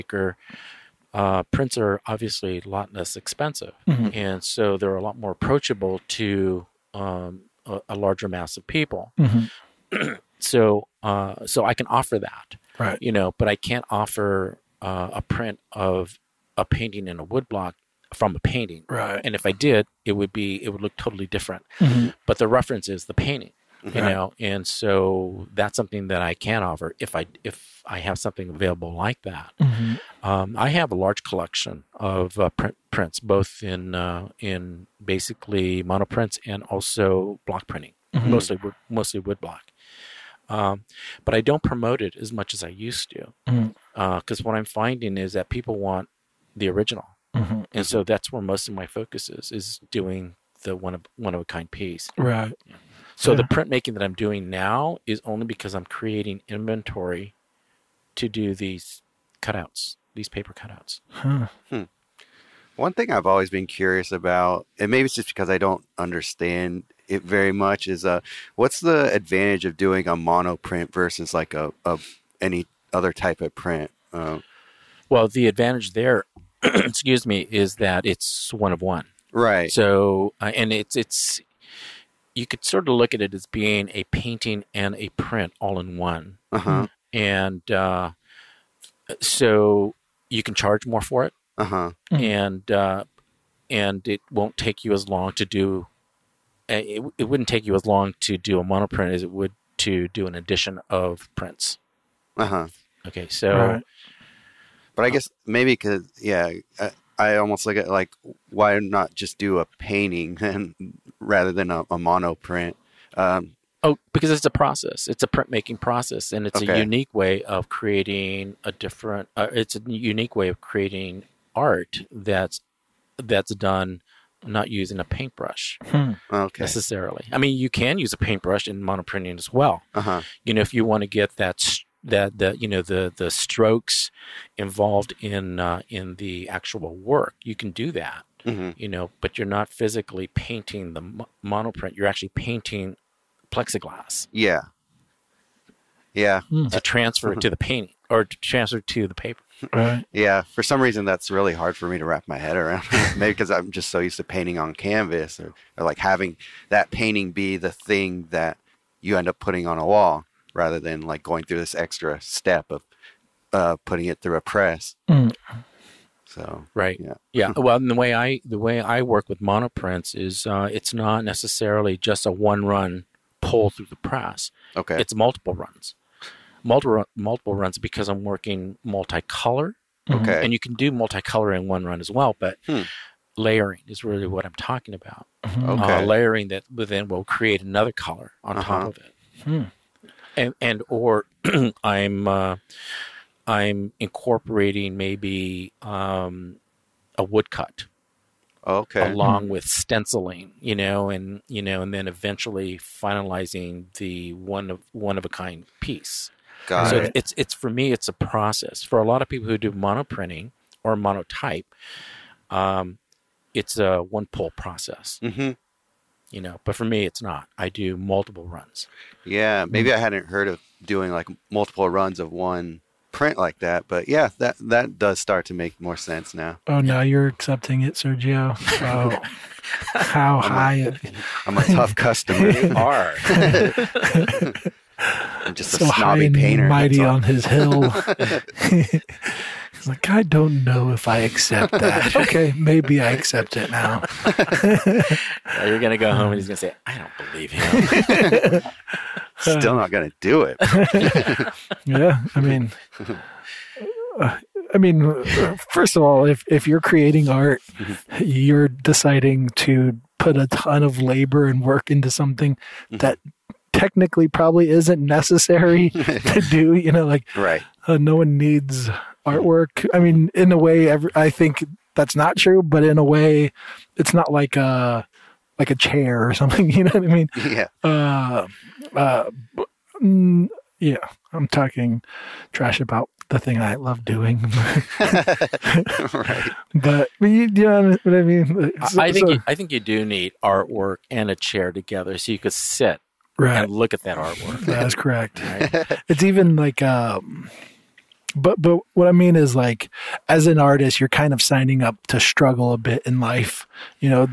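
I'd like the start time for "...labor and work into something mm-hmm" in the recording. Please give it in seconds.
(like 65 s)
261 s.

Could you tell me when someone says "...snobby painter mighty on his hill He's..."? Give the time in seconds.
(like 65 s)
235 s.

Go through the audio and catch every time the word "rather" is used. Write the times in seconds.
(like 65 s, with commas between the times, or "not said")
111 s, 160 s.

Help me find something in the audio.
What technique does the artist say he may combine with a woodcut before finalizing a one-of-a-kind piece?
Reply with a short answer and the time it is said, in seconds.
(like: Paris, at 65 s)
Stenciling, at 199 s.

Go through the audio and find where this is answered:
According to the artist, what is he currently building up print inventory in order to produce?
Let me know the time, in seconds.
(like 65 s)
60 s.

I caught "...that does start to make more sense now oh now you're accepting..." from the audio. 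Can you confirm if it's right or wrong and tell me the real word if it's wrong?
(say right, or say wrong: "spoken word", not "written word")
right.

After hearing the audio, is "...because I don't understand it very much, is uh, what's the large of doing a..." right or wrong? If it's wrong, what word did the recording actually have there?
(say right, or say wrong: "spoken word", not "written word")
wrong: "advantage", not "large".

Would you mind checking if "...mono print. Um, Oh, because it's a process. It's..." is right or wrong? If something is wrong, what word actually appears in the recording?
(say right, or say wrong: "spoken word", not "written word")
right.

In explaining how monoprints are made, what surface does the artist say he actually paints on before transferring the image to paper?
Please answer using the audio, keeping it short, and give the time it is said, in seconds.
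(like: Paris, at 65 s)
Plexiglass, at 143 s.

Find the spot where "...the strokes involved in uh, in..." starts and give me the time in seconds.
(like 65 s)
133 s.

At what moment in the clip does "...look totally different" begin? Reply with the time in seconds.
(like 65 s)
20 s.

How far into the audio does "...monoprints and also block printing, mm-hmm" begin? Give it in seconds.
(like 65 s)
35 s.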